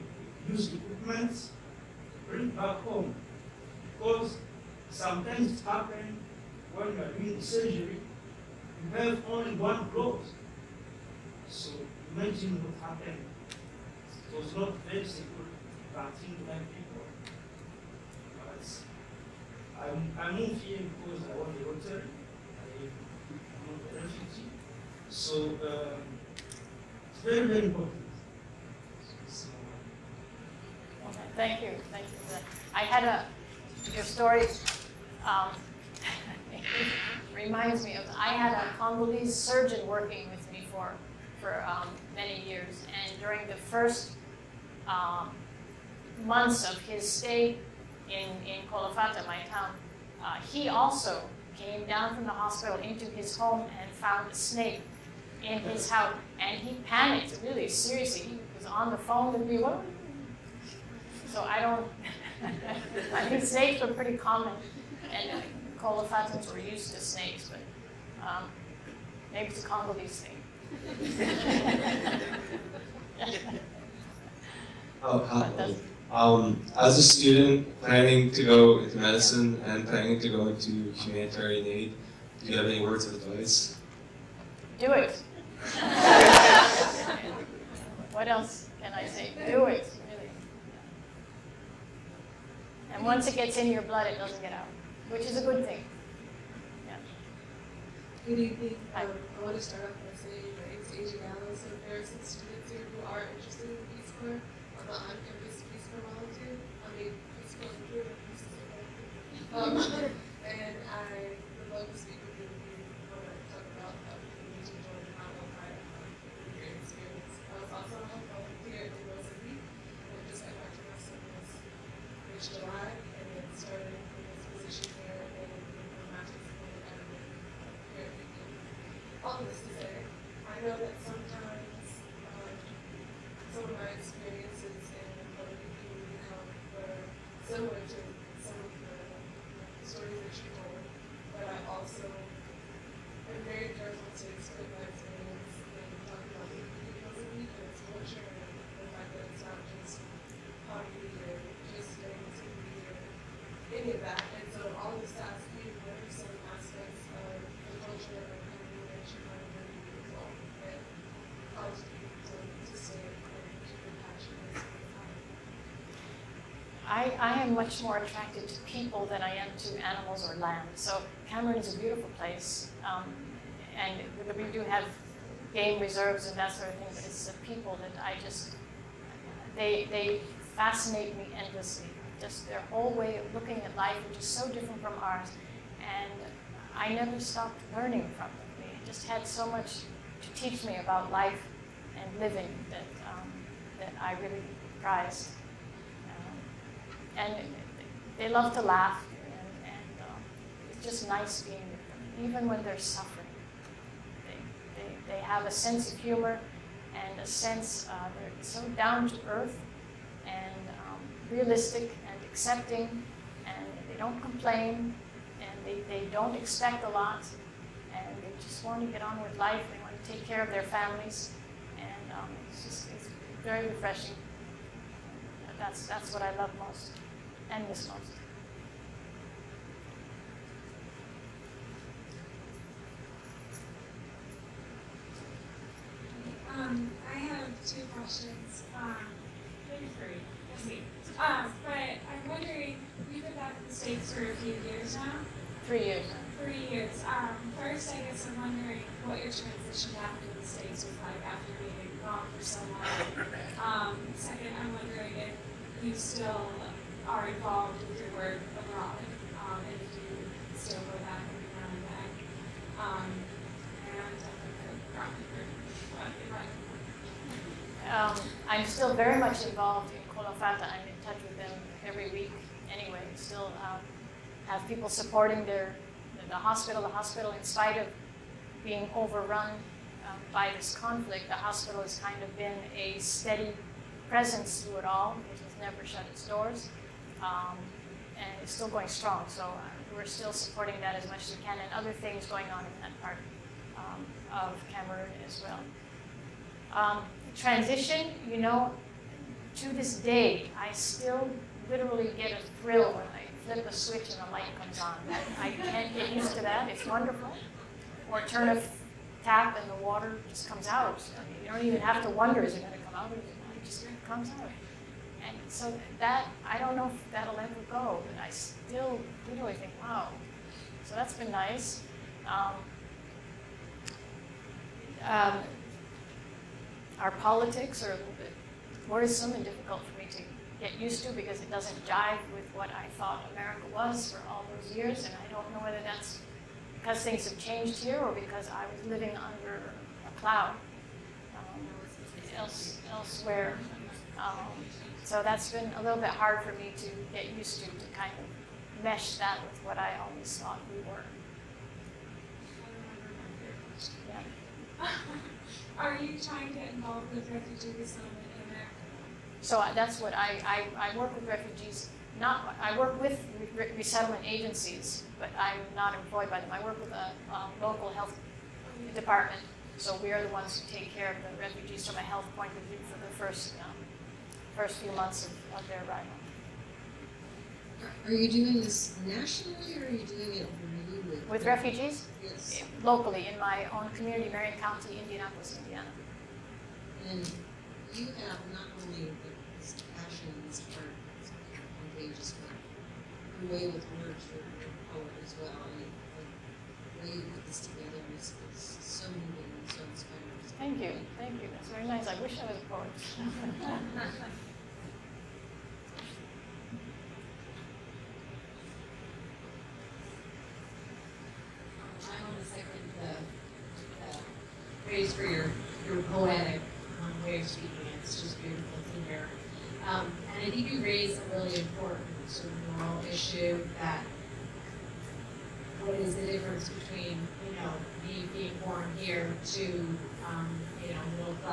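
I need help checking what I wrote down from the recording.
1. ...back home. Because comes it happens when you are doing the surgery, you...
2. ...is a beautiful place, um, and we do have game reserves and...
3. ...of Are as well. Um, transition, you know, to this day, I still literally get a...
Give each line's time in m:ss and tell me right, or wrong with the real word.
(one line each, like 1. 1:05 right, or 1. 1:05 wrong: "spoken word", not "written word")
1. 0:02 wrong: "sometimes", not "comes"
2. 2:51 right
3. 4:54 wrong: "Cameroon", not "Are".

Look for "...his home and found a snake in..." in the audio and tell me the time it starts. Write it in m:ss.
0:53.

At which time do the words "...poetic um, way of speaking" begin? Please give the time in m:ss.
6:56.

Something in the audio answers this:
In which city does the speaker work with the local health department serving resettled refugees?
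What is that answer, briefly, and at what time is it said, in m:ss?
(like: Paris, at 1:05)
Indianapolis, at 6:25.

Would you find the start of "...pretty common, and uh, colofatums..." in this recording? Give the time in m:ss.
1:03.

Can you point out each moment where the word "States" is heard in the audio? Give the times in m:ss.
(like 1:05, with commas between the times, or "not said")
4:03, 4:10.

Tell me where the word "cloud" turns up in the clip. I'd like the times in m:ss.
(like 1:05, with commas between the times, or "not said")
5:40.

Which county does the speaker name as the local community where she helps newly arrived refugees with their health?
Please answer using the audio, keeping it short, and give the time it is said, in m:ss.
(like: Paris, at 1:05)
Marion County, at 6:24.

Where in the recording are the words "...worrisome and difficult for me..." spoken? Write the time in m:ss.
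5:28.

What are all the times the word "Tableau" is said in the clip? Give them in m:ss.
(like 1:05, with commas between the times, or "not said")
not said.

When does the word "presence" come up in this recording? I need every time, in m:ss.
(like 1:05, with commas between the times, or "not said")
4:44.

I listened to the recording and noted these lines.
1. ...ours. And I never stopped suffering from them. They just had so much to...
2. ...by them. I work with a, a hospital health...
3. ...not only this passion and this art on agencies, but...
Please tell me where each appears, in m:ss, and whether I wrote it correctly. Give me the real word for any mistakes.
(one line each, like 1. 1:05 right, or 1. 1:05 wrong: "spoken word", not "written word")
1. 3:05 wrong: "learning", not "suffering"
2. 6:06 wrong: "local", not "hospital"
3. 6:28 wrong: "pages", not "agencies".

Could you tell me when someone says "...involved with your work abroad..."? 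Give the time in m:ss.
4:17.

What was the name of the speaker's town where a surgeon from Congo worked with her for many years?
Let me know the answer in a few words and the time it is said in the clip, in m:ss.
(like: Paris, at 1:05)
Kolofata, at 0:48.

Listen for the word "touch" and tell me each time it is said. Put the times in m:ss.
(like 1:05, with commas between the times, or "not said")
4:31.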